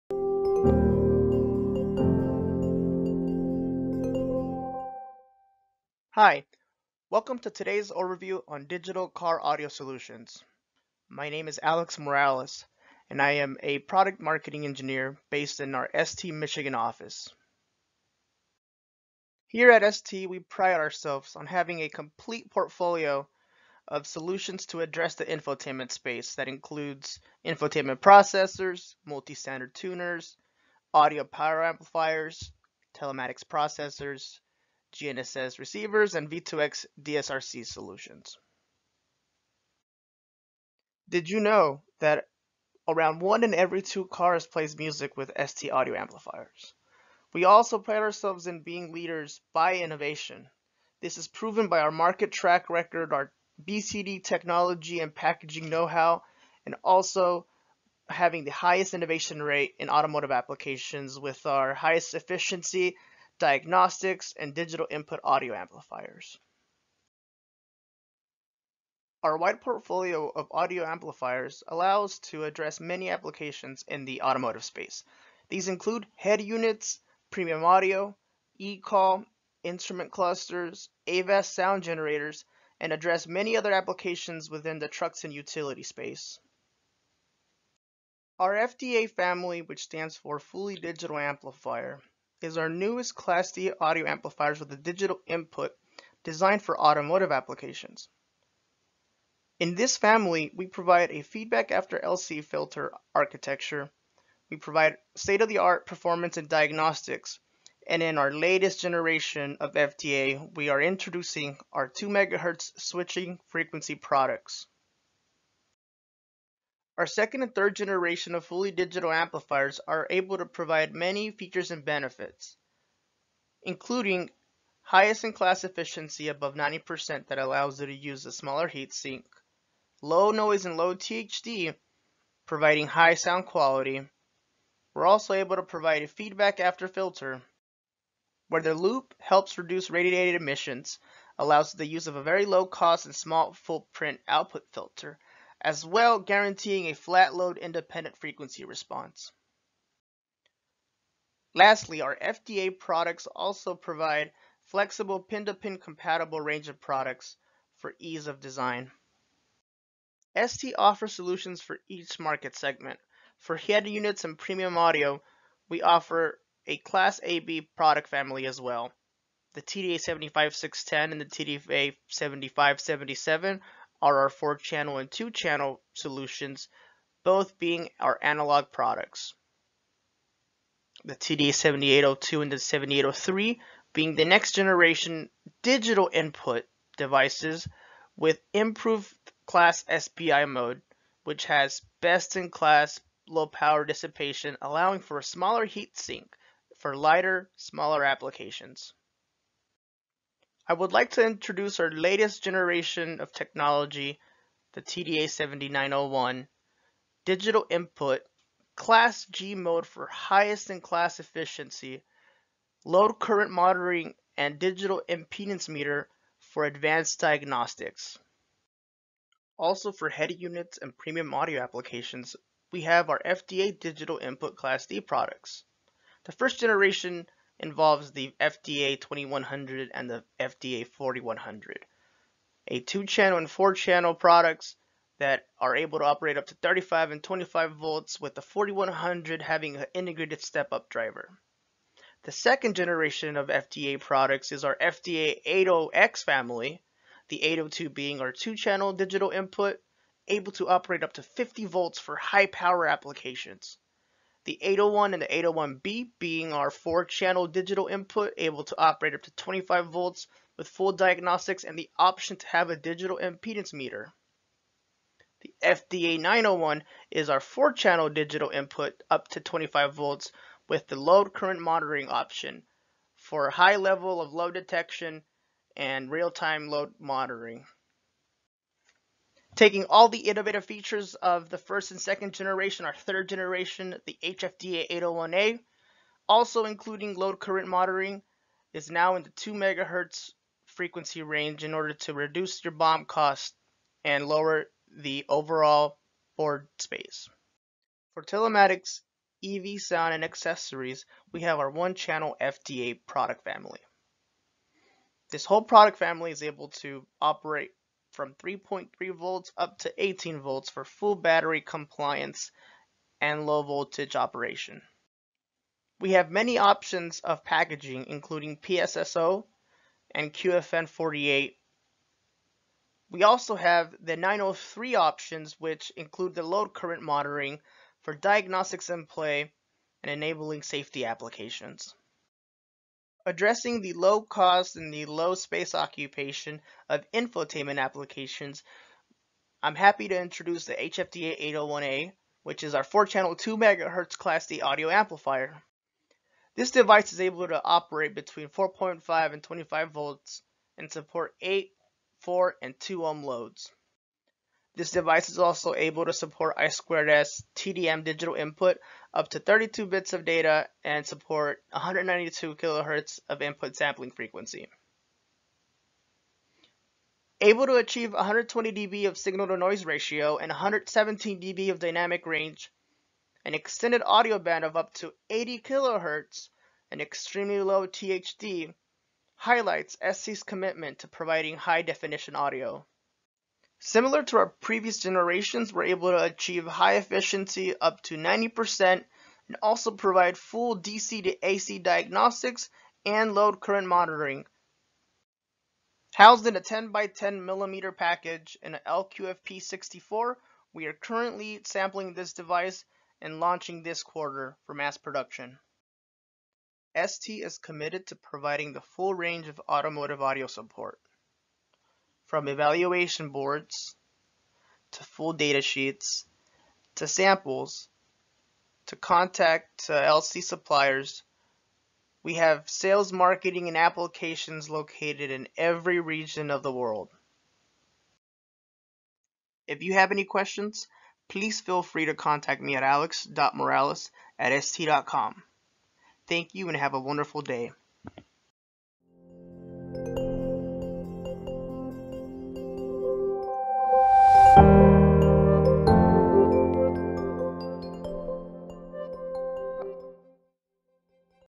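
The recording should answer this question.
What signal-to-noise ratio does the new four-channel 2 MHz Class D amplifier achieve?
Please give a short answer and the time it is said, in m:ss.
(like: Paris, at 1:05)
120 dB, at 6:08.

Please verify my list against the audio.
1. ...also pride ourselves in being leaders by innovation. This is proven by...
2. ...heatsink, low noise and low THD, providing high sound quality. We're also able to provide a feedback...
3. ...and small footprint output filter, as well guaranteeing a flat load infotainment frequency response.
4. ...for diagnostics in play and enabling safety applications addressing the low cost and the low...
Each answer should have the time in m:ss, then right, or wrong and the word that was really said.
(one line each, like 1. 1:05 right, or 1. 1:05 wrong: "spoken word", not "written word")
1. 0:47 right
2. 2:08 right
3. 2:23 wrong: "independent", not "infotainment"
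4. 5:28 right.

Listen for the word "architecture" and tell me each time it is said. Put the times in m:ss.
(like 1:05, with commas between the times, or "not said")
1:43.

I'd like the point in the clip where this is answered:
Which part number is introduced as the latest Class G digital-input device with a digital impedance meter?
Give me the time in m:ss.
3:24.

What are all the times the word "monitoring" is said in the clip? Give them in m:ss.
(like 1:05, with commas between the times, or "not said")
3:33, 4:31, 4:36, 4:47, 5:27, 6:33.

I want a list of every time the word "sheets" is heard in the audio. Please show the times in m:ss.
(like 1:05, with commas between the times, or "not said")
6:55.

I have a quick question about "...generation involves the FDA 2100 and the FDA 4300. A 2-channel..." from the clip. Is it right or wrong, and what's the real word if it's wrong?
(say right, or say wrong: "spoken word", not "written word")
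wrong: "4100", not "4300".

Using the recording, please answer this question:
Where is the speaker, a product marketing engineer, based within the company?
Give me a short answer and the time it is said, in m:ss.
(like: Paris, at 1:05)
Michigan office, at 0:16.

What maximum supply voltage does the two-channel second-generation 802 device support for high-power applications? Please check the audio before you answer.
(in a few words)
50 volts.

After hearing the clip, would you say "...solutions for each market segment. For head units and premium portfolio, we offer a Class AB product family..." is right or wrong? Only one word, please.
wrong.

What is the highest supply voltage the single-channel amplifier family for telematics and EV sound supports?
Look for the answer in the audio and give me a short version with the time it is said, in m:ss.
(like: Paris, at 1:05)
18 volts, at 5:10.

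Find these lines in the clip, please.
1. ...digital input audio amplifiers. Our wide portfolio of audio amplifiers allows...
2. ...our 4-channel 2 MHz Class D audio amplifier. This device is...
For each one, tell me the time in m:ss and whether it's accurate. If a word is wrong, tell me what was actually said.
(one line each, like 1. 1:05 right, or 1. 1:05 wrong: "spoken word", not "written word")
1. 1:04 right
2. 5:42 right.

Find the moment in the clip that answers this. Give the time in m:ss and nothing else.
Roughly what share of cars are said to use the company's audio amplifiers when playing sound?
0:43.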